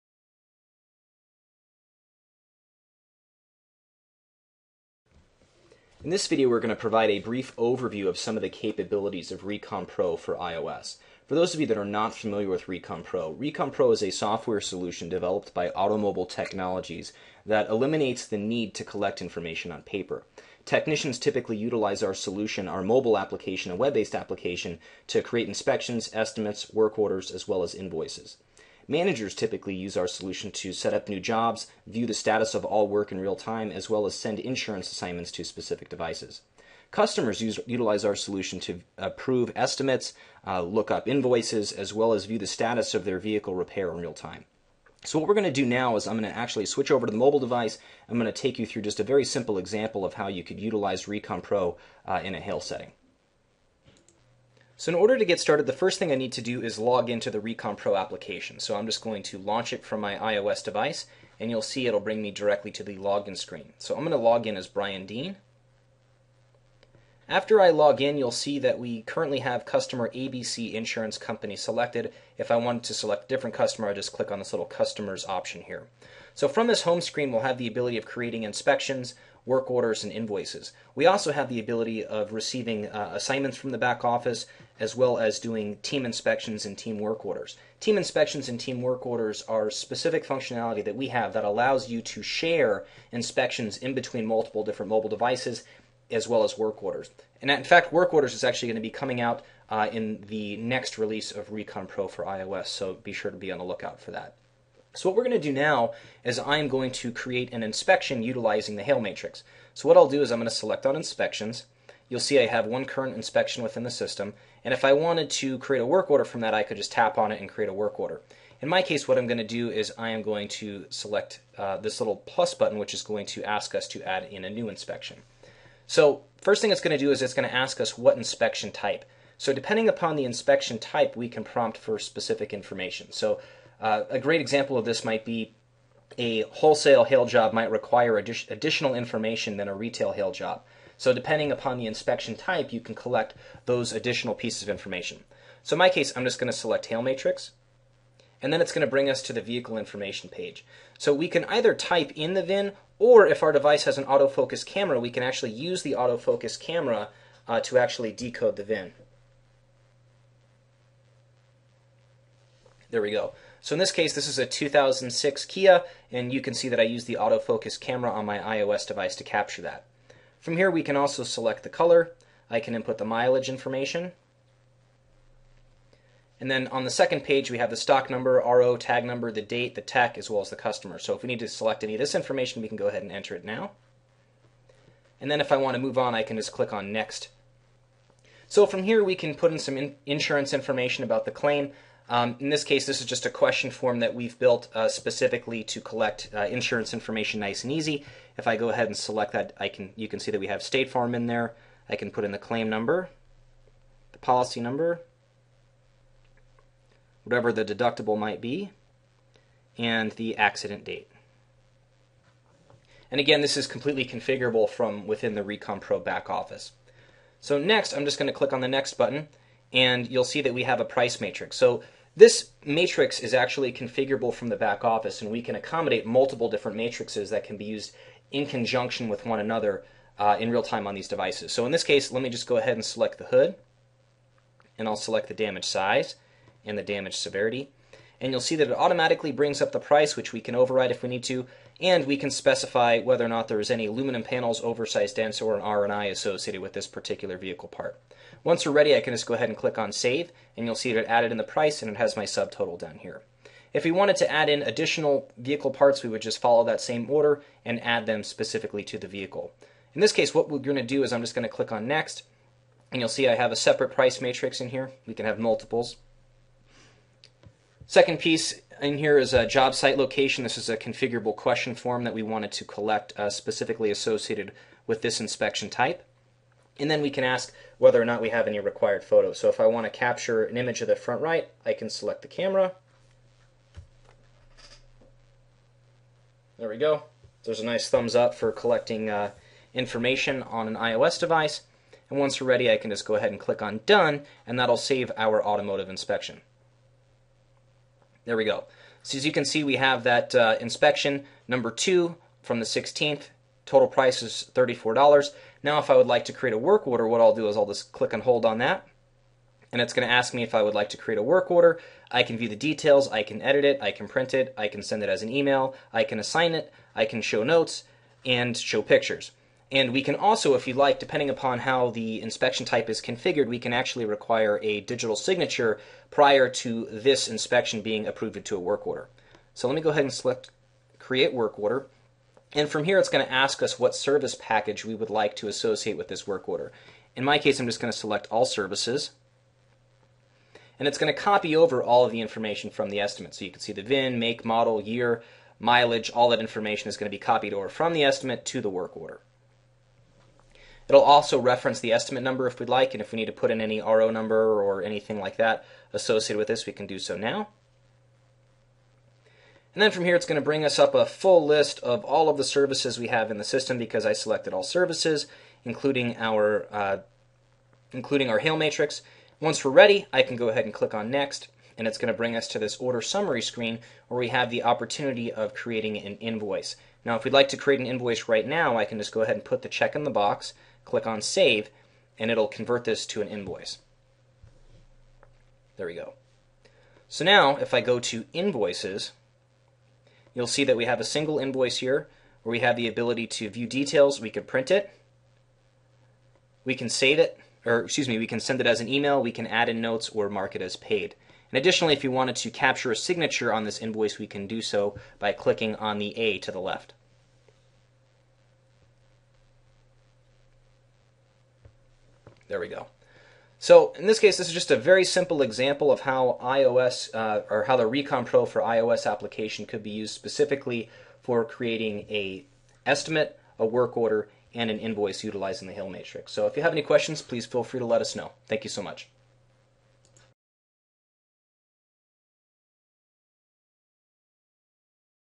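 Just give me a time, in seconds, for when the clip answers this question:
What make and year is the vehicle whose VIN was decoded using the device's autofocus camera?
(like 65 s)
164 s.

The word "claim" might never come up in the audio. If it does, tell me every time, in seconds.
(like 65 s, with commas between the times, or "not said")
191 s, 202 s.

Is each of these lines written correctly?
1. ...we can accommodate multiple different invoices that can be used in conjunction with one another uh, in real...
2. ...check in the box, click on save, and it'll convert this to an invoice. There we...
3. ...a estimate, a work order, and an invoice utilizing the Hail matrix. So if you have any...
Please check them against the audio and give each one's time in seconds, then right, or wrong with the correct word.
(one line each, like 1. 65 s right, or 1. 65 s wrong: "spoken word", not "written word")
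1. 225 s wrong: "matrices", not "invoices"
2. 379 s right
3. 422 s right.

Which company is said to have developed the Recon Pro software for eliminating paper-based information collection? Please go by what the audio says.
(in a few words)
Automobile Technologies.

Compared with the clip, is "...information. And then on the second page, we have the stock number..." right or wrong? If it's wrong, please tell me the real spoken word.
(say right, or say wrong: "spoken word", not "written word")
right.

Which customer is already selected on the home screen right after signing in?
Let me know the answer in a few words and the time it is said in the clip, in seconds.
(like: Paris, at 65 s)
ABC Insurance Company, at 70 s.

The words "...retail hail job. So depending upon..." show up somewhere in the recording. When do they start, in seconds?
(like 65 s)
139 s.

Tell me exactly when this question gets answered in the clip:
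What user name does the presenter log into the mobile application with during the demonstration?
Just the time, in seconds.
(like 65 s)
64 s.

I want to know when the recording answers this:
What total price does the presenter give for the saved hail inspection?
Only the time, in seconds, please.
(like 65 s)
304 s.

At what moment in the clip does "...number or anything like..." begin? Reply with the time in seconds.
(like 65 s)
354 s.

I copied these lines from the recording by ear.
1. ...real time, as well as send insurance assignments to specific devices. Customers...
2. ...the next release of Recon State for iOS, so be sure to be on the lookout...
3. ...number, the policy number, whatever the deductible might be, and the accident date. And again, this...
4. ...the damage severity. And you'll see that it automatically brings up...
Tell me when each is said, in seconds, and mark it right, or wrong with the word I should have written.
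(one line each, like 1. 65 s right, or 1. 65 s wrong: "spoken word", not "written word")
1. 33 s right
2. 100 s wrong: "Pro", not "State"
3. 202 s right
4. 236 s right.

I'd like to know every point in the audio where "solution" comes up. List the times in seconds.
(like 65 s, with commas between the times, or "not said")
14 s, 22 s, 30 s, 38 s.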